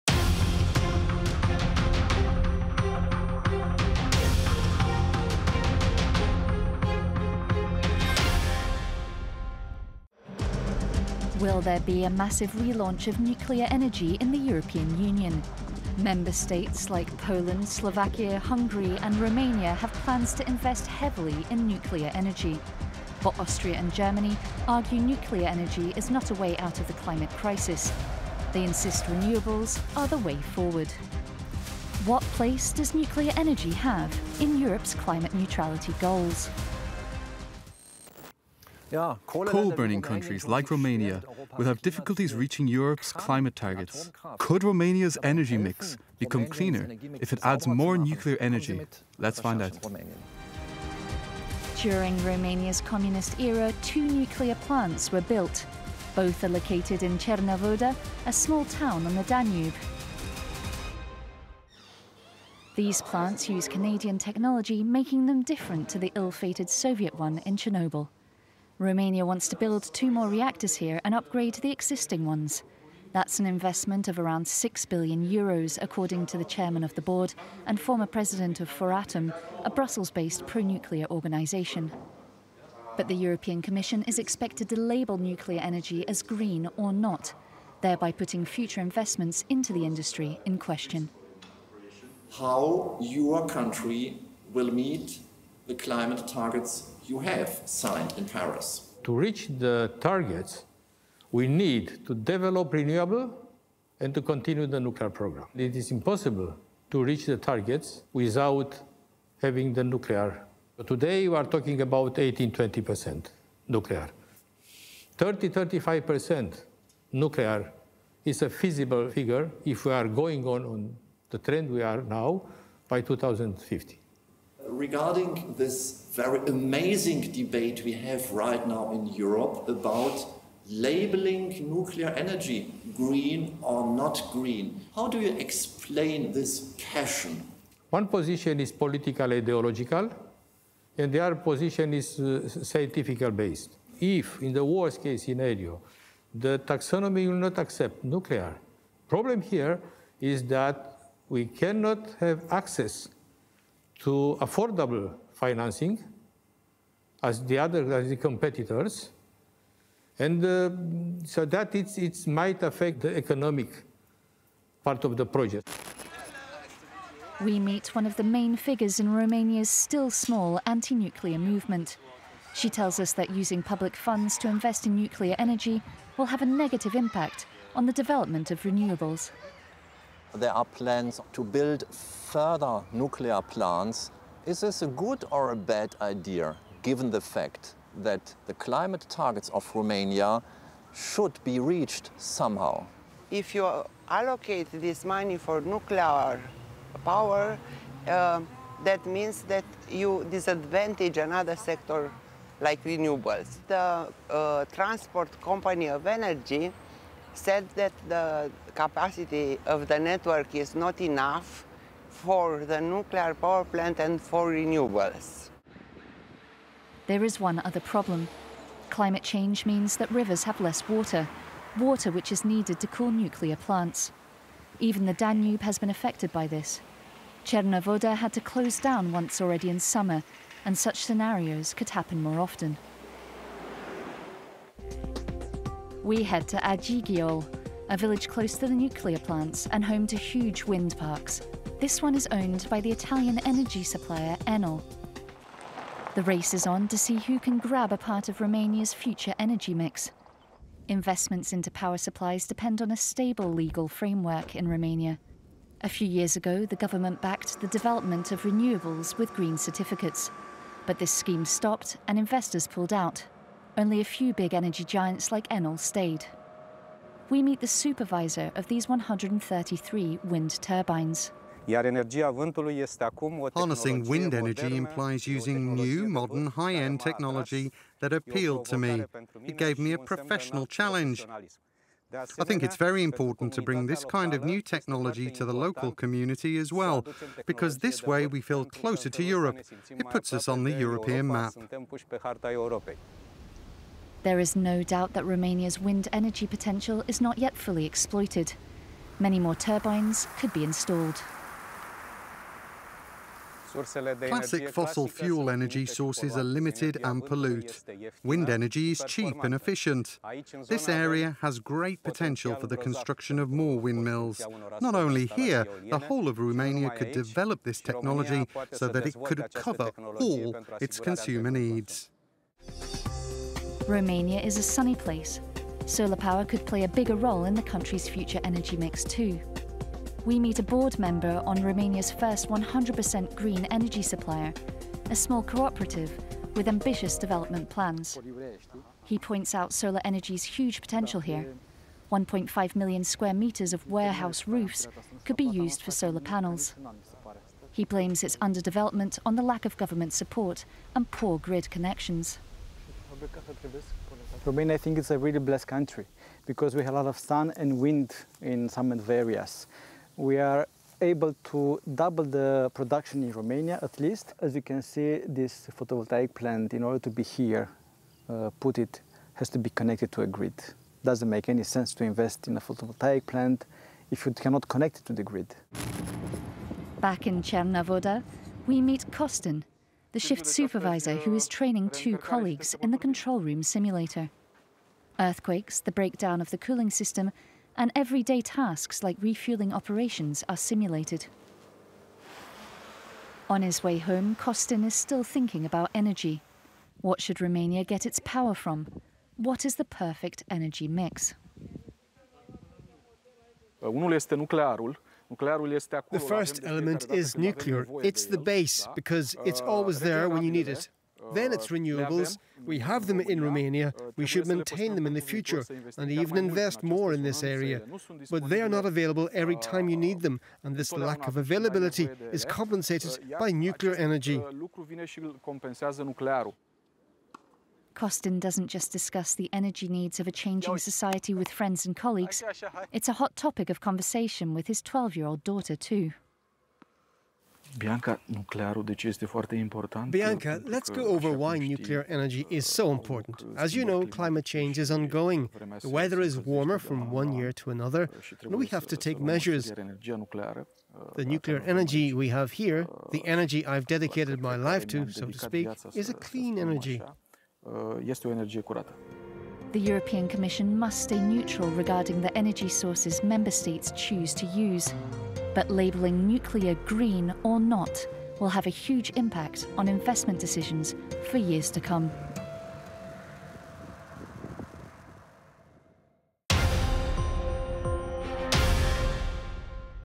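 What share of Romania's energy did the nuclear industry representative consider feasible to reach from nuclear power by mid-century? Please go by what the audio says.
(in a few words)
30-35%.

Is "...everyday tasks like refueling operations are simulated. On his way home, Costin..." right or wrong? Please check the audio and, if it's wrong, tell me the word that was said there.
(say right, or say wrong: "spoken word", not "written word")
right.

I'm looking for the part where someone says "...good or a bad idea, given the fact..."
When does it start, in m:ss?
3:04.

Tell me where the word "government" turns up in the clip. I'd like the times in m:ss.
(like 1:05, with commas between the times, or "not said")
4:16, 5:49.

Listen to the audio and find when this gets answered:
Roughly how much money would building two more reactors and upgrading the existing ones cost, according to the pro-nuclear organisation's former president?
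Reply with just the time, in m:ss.
1:14.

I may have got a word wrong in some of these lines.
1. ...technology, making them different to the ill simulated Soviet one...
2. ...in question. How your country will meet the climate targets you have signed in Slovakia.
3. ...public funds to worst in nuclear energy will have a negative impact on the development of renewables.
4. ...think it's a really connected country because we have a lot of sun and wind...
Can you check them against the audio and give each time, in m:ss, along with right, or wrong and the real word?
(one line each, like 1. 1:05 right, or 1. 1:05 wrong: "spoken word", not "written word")
1. 1:04 wrong: "fated", not "simulated"
2. 1:30 wrong: "Paris", not "Slovakia"
3. 2:53 wrong: "invest", not "worst"
4. 5:54 wrong: "blessed", not "connected".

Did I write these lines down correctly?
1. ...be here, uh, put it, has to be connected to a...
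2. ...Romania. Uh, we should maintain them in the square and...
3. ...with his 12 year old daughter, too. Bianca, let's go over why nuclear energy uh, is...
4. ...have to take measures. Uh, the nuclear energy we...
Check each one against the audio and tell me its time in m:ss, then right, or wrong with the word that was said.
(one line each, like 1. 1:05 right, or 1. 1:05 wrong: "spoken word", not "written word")
1. 6:07 right
2. 6:53 wrong: "future", not "square"
3. 7:14 right
4. 7:28 right.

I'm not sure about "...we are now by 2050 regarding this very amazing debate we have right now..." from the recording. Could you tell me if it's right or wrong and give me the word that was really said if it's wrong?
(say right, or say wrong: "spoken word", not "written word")
right.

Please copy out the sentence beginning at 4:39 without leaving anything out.
It gave me a professional challenge.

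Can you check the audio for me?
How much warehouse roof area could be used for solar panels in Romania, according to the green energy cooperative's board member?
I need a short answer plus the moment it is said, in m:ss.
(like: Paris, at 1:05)
1.5 million square metres, at 5:42.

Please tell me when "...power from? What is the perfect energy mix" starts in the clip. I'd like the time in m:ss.
6:38.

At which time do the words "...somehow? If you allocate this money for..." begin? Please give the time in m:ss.
3:12.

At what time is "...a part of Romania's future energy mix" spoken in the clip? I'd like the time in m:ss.
4:07.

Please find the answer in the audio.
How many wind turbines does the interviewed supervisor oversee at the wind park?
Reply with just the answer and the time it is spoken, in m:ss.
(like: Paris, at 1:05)
133, at 4:28.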